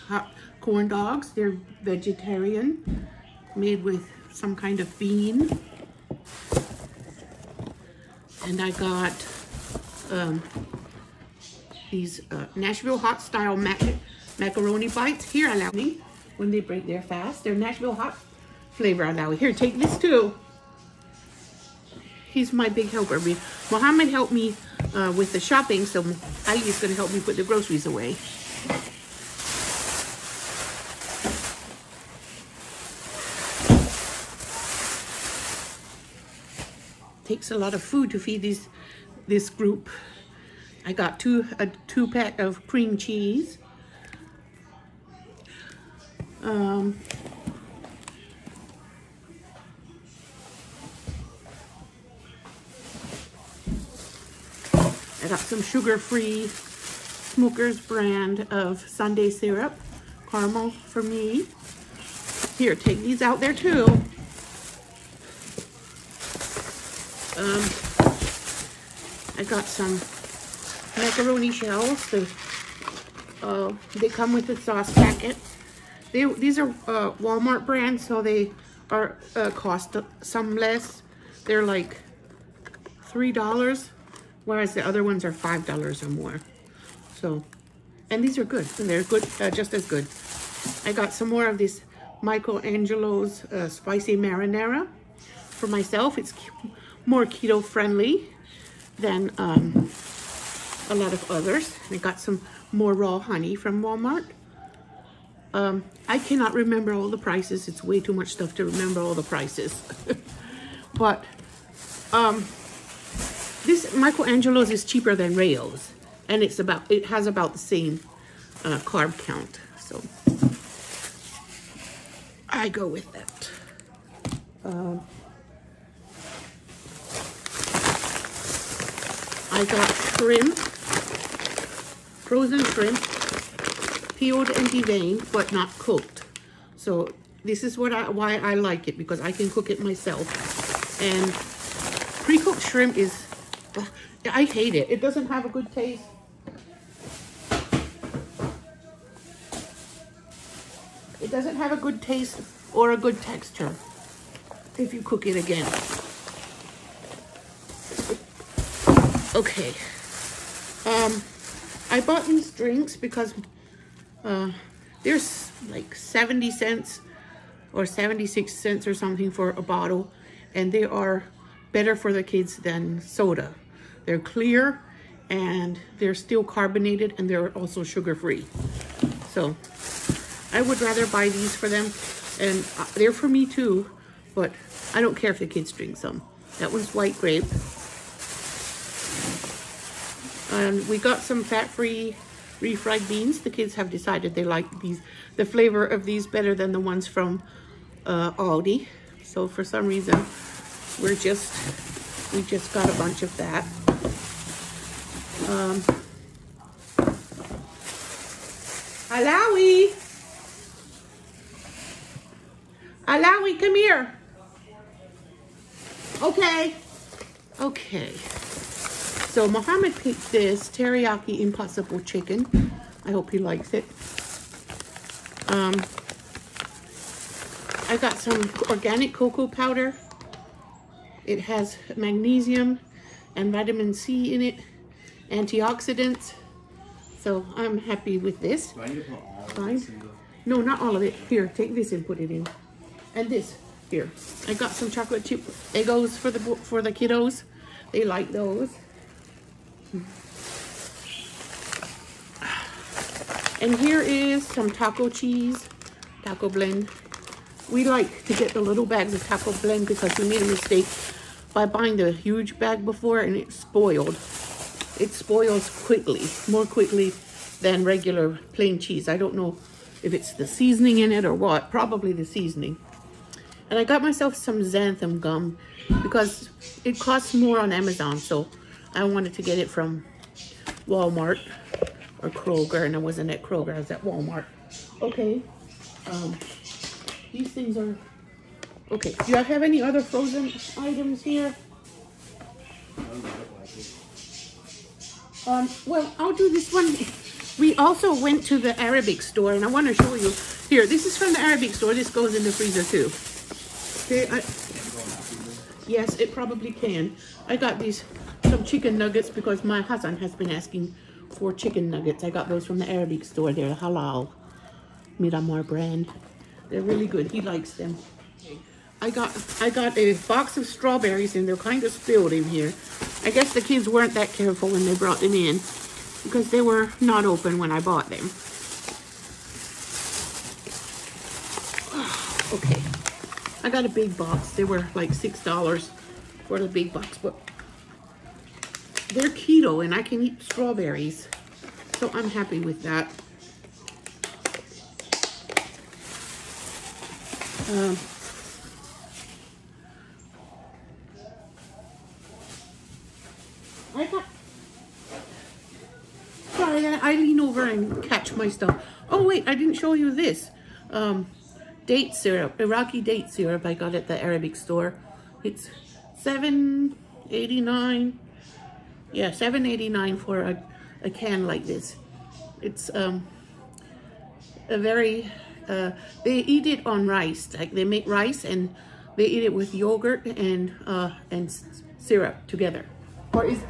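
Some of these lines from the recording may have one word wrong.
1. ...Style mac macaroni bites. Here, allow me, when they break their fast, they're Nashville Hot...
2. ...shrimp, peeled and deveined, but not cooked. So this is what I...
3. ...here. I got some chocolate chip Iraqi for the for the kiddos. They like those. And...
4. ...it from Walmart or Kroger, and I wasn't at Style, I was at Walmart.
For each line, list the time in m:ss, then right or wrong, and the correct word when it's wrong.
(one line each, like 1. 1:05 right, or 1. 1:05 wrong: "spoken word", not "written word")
1. 0:13 right
2. 2:12 right
3. 4:03 wrong: "Eggos", not "Iraqi"
4. 4:39 wrong: "Kroger", not "Style".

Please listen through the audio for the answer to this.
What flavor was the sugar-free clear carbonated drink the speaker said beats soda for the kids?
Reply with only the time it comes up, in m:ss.
3:06.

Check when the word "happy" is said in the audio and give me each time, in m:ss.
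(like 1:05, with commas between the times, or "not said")
3:57, 5:42.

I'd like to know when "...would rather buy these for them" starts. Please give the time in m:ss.
3:00.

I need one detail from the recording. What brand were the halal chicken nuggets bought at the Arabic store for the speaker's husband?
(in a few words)
Midamar.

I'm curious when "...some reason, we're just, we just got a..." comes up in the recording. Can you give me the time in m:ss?
3:19.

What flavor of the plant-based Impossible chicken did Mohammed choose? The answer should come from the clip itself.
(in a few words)
Teriyaki.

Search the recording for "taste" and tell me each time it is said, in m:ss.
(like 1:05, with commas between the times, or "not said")
2:25, 2:32.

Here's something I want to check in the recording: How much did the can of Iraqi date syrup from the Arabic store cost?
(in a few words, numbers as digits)
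$7.89.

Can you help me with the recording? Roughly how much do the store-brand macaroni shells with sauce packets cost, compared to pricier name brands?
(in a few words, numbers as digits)
$3.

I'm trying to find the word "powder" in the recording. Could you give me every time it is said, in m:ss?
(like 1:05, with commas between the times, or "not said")
3:49.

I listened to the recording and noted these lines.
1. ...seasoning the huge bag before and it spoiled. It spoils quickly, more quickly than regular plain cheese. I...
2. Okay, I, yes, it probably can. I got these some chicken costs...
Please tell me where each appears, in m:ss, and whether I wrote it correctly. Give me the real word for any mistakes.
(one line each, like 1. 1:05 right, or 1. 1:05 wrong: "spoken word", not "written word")
1. 4:21 wrong: "buying", not "seasoning"
2. 5:04 wrong: "nuggets", not "costs".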